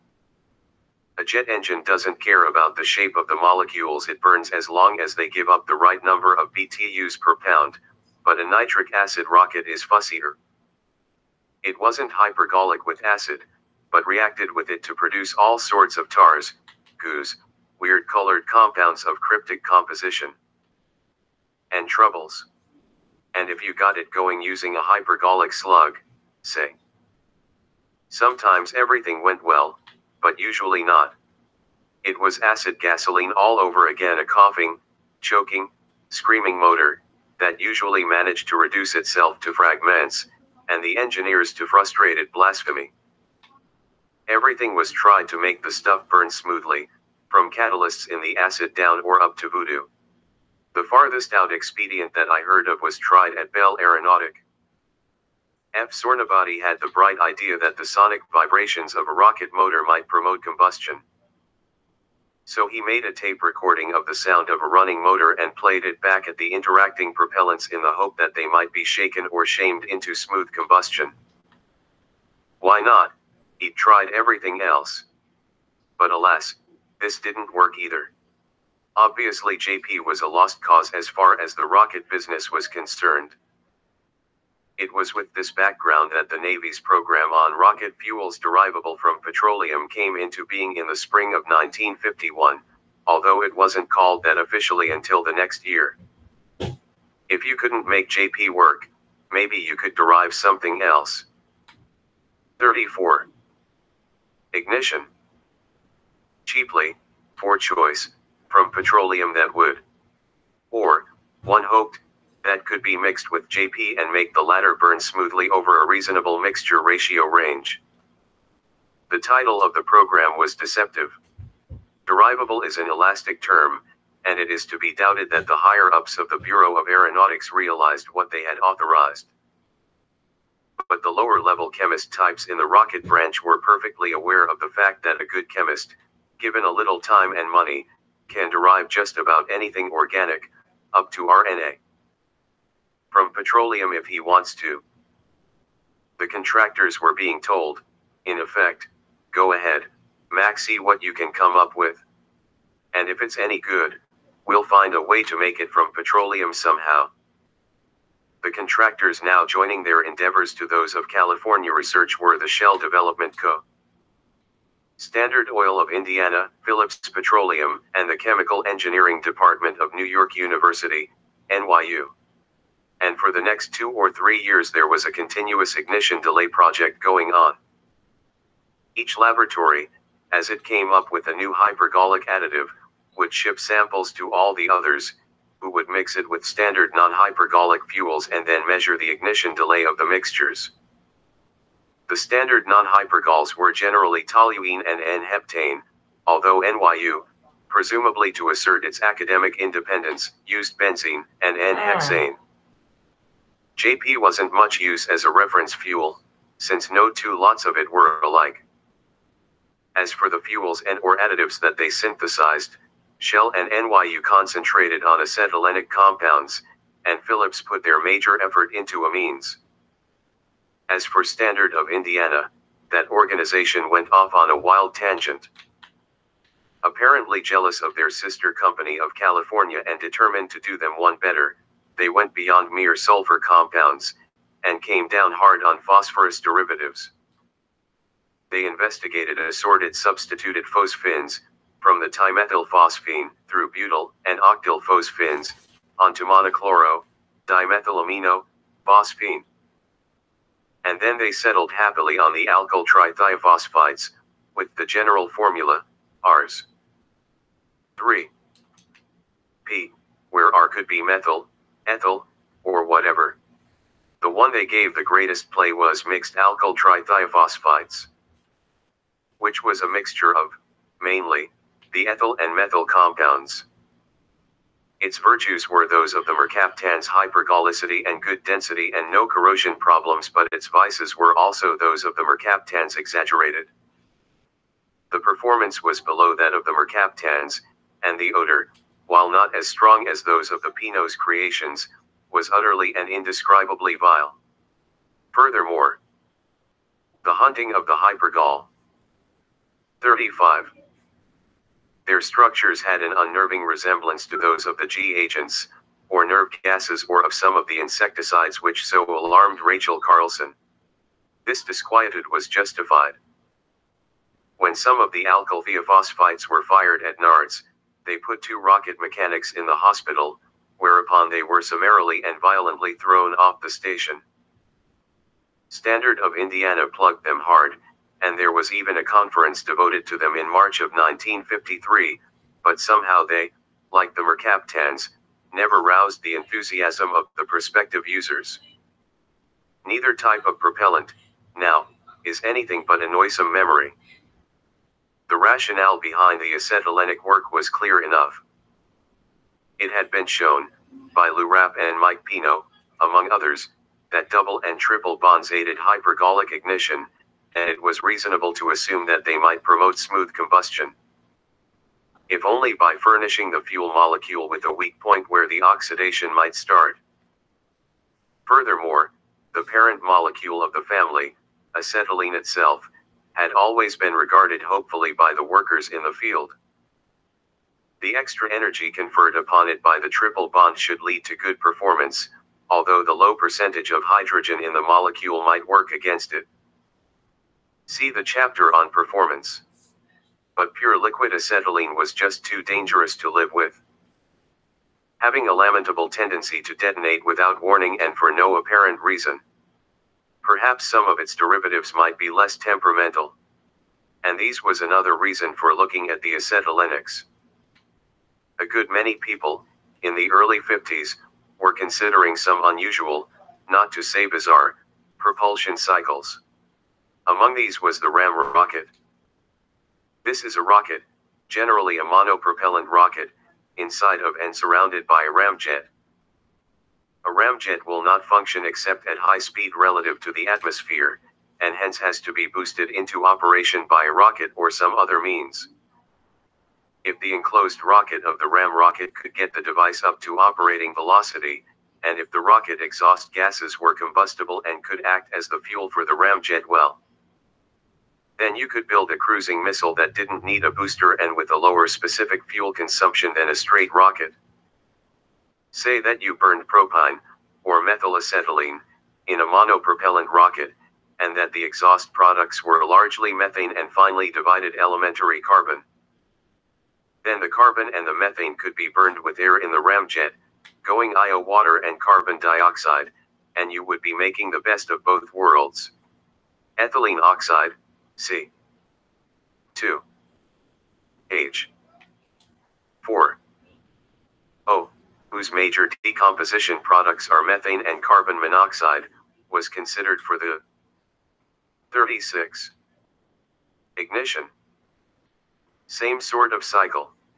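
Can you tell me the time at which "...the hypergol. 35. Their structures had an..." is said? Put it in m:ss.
4:57.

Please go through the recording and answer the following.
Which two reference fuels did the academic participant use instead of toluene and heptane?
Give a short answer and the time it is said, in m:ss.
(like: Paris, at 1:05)
benzene and N-hexane, at 3:20.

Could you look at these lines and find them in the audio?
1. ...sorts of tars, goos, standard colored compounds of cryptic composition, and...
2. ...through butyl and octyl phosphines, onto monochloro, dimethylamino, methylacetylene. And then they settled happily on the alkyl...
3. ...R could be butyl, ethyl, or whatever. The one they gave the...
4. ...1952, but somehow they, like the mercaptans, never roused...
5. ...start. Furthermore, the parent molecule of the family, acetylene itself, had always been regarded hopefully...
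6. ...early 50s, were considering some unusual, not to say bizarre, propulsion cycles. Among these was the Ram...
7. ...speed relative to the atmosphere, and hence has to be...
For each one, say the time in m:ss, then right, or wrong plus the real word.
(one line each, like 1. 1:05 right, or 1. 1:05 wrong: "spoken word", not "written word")
1. 0:15 wrong: "weird", not "standard"
2. 4:03 wrong: "phosphine", not "methylacetylene"
3. 4:20 wrong: "methyl", not "butyl"
4. 5:30 wrong: "1953", not "1952"
5. 6:06 right
6. 6:50 right
7. 7:09 right.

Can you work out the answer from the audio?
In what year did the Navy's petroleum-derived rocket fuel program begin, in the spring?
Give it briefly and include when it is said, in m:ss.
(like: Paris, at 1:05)
1951, at 1:31.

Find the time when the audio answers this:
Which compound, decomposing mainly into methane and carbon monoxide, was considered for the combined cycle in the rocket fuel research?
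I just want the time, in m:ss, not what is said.
7:56.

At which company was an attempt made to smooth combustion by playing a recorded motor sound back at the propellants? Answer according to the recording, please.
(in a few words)
Bell Aeronautic.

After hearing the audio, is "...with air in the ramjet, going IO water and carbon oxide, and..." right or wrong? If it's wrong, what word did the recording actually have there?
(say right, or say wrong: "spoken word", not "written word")
wrong: "dioxide", not "oxide".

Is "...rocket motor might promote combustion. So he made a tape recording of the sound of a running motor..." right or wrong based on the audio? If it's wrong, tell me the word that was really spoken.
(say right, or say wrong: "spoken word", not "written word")
right.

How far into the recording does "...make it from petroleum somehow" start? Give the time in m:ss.
2:35.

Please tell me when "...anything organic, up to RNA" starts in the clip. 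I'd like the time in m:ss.
2:19.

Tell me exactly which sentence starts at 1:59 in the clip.
The title of the program was deceptive.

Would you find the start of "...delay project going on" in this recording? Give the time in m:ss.
2:56.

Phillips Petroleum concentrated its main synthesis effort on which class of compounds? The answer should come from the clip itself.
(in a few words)
amines.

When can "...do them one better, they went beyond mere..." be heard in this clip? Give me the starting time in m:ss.
3:50.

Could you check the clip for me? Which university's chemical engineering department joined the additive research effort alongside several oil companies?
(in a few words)
New York University.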